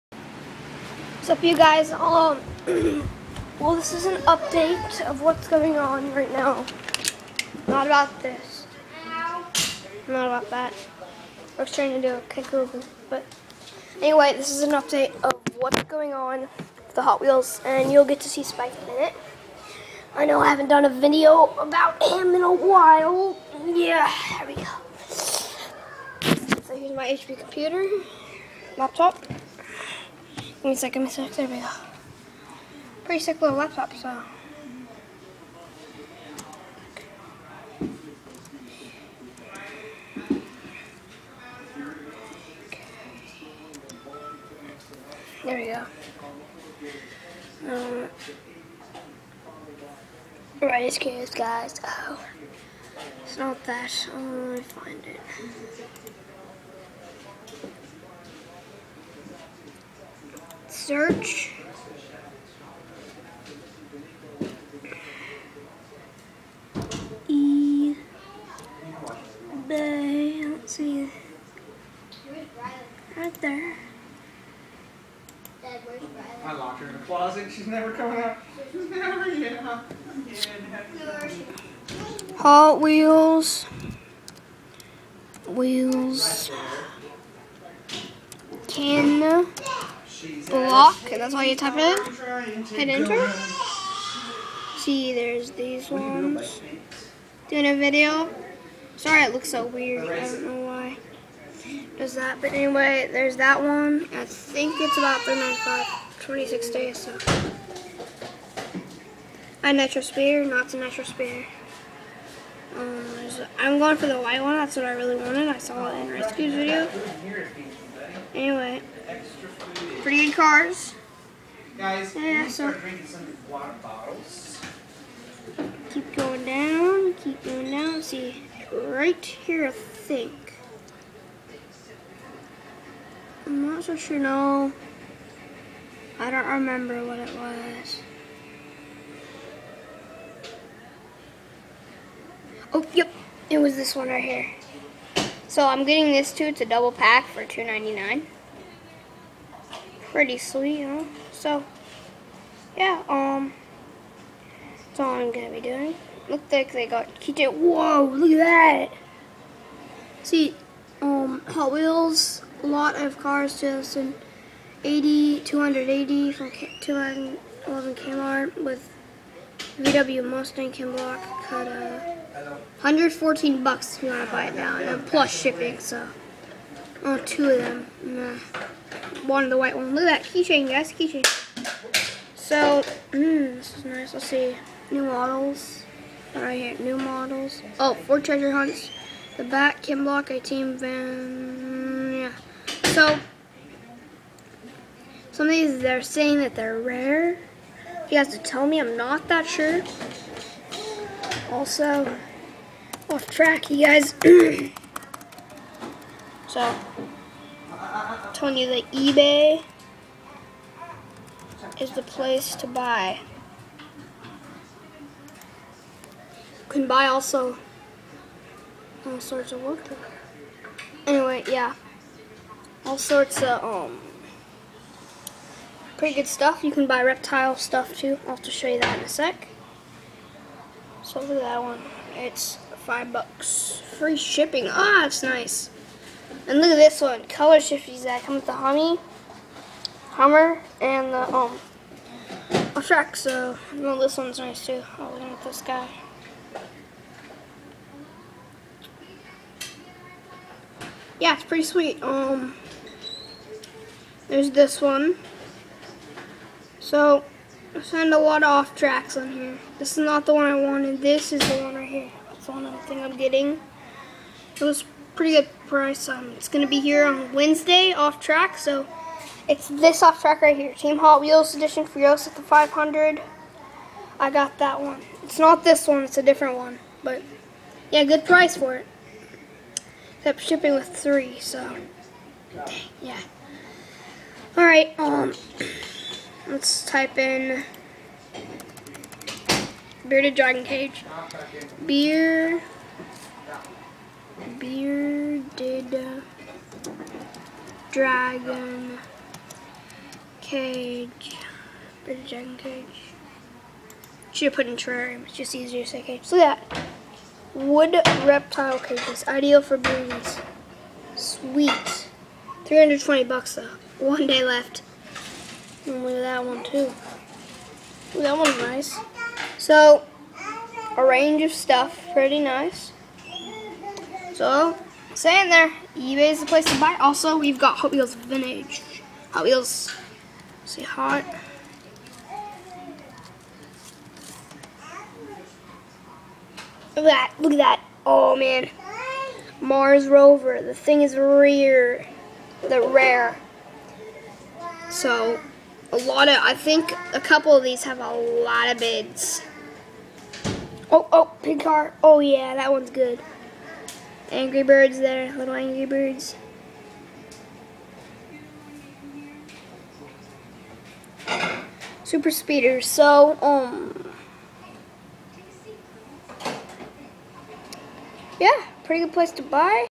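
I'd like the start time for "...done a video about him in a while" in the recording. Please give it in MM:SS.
00:20.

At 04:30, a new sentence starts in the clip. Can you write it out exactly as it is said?
Team Hot Wheels Edition Furios at the 500.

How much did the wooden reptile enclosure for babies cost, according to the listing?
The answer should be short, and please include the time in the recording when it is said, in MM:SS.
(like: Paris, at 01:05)
320 bucks, at 05:12.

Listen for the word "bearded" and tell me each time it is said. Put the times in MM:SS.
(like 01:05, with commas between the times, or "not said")
04:50, 04:54, 05:02.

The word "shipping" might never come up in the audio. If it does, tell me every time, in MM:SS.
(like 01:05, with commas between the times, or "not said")
02:55, 03:54, 04:40.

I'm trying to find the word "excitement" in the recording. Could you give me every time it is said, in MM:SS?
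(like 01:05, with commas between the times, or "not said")
not said.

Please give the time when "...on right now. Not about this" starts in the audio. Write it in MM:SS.
00:05.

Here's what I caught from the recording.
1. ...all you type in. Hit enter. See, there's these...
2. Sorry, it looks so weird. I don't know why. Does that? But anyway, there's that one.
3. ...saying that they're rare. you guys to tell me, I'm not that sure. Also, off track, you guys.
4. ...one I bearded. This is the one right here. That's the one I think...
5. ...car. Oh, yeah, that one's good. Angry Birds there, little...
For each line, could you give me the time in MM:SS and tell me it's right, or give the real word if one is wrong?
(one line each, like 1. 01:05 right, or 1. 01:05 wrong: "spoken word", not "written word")
1. 01:31 right
2. 01:38 right
3. 03:16 right
4. 04:20 wrong: "wanted", not "bearded"
5. 05:51 right.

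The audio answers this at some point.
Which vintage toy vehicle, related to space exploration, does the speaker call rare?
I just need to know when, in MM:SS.
05:39.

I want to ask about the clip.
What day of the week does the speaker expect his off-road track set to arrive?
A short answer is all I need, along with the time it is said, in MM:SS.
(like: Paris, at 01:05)
Wednesday, at 04:27.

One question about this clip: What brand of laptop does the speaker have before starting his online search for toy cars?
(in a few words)
HP.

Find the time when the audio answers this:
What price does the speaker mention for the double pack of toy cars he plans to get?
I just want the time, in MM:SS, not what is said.
02:27.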